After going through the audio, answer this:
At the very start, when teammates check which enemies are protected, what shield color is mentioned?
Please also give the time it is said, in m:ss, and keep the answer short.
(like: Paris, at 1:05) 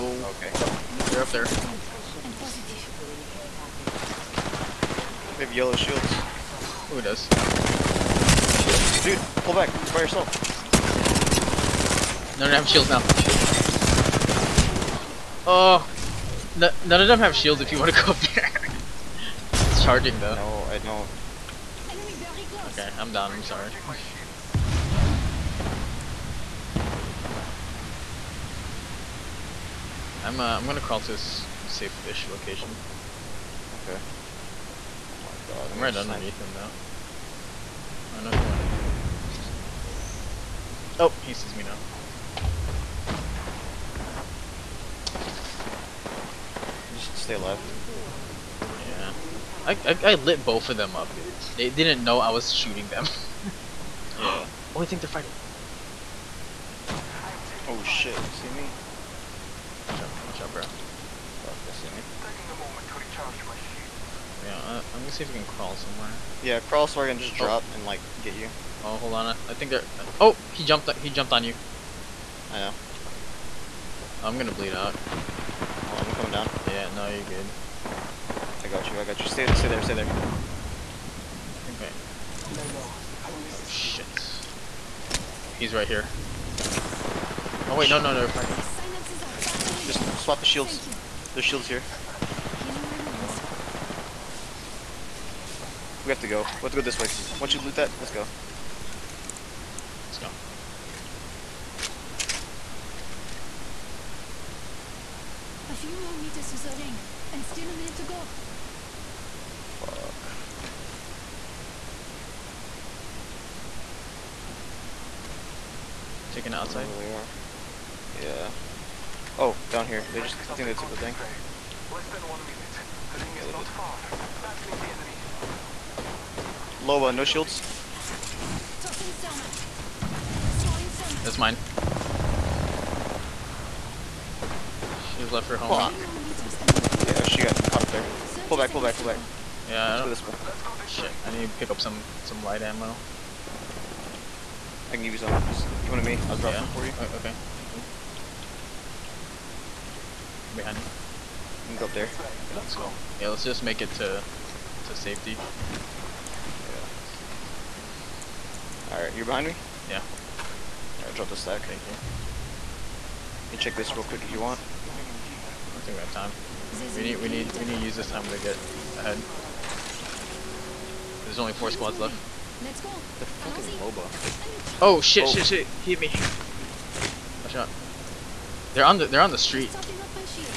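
Yellow, at 0:05.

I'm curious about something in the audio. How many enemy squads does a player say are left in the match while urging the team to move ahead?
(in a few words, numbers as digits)
4.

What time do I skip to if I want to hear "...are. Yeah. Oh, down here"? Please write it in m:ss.
1:58.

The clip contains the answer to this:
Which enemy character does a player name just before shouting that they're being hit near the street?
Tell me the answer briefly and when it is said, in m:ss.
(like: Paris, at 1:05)
Loba, at 2:53.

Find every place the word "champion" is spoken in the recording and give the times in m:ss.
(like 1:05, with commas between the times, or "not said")
not said.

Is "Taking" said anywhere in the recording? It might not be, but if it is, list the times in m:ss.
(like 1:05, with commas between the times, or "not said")
1:02, 1:56.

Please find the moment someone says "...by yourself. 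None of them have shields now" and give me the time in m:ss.
0:09.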